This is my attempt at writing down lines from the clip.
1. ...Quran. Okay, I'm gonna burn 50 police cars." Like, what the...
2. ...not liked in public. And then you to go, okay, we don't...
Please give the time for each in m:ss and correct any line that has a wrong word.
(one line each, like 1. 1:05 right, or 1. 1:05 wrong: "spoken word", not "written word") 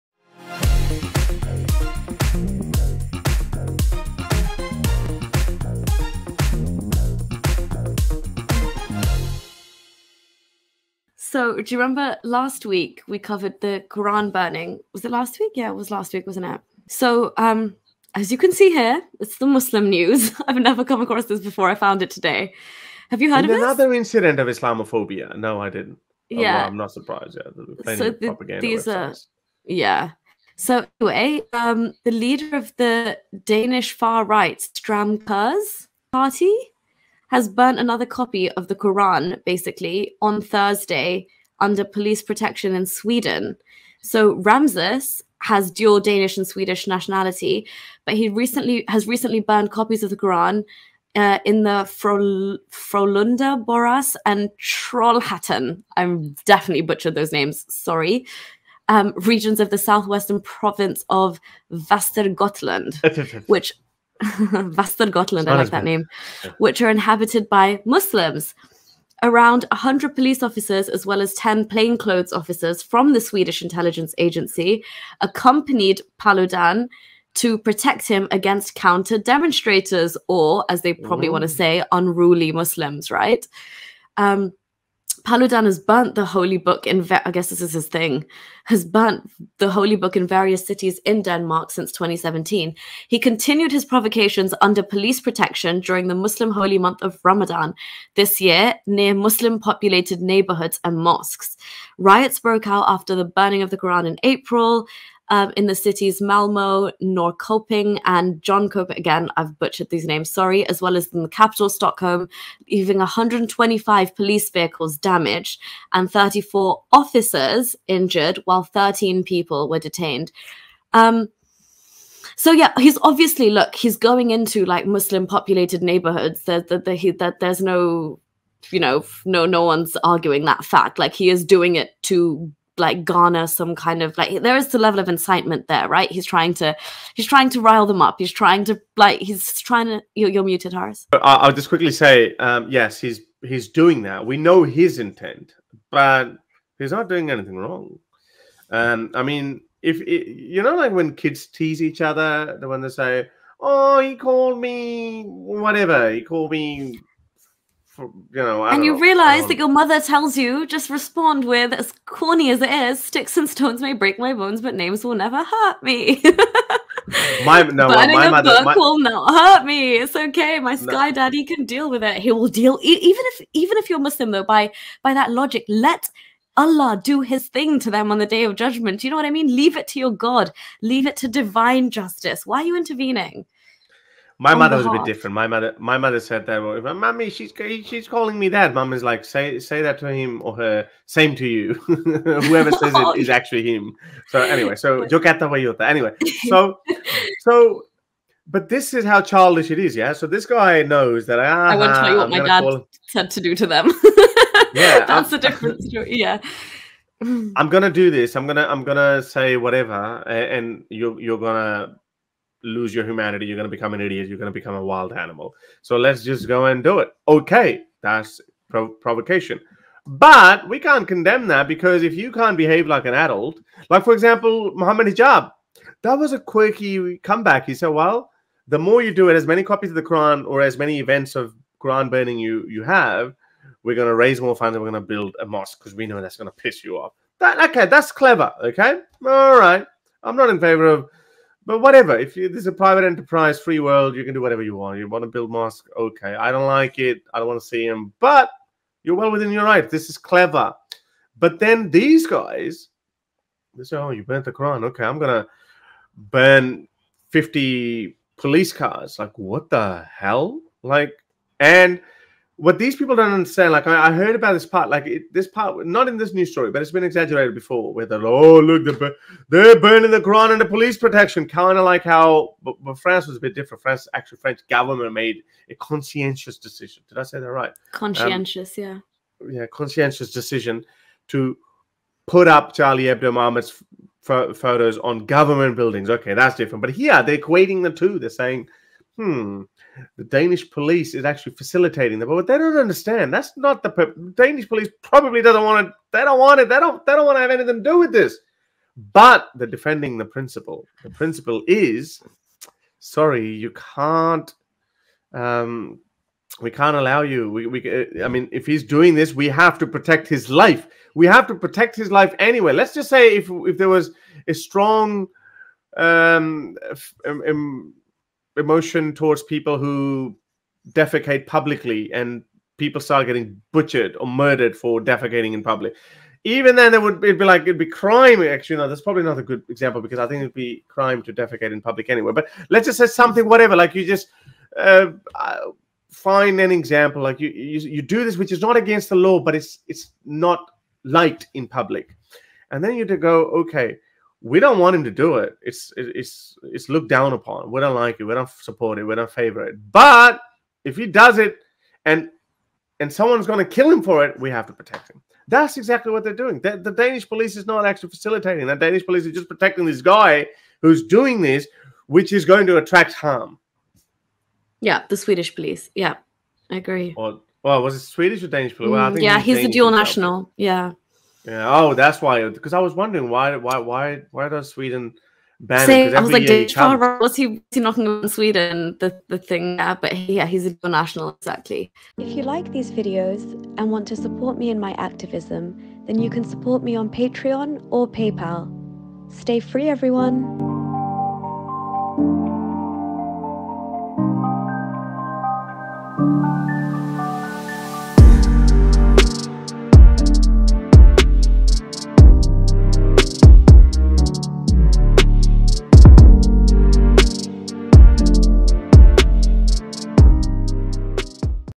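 1. 4:14 right
2. 5:40 right.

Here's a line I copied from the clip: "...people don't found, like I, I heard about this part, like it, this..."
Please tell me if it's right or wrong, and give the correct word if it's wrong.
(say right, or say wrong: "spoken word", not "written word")
wrong: "understand", not "found".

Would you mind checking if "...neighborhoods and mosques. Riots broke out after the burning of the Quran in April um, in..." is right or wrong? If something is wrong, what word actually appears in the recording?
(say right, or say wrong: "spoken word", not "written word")
right.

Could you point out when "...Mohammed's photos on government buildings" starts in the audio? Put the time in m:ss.
4:43.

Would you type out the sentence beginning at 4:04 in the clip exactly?
You want to build mosque, okay.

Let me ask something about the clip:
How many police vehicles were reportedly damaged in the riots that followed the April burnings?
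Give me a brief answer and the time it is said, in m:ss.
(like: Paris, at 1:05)
125, at 1:52.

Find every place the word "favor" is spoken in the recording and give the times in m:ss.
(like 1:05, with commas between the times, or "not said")
4:00, 5:49.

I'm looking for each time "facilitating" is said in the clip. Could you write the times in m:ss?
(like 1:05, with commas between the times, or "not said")
4:51, 5:58.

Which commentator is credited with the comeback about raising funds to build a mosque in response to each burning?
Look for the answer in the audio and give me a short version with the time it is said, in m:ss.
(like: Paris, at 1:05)
Muhammad Hijab, at 3:44.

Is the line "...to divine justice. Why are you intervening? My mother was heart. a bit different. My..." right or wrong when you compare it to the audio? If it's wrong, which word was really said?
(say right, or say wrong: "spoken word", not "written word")
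right.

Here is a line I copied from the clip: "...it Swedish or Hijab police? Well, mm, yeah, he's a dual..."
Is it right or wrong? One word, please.
wrong.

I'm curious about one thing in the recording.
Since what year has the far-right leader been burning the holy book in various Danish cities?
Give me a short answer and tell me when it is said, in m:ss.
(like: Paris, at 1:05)
2017, at 1:31.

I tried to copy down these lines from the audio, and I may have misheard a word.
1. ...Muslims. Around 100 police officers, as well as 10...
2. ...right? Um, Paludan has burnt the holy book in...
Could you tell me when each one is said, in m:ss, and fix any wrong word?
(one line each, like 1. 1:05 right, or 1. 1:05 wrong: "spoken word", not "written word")
1. 1:07 right
2. 1:23 right.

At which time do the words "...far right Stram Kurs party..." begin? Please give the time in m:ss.
0:33.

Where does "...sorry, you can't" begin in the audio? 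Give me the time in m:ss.
5:02.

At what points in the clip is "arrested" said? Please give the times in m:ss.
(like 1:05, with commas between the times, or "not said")
not said.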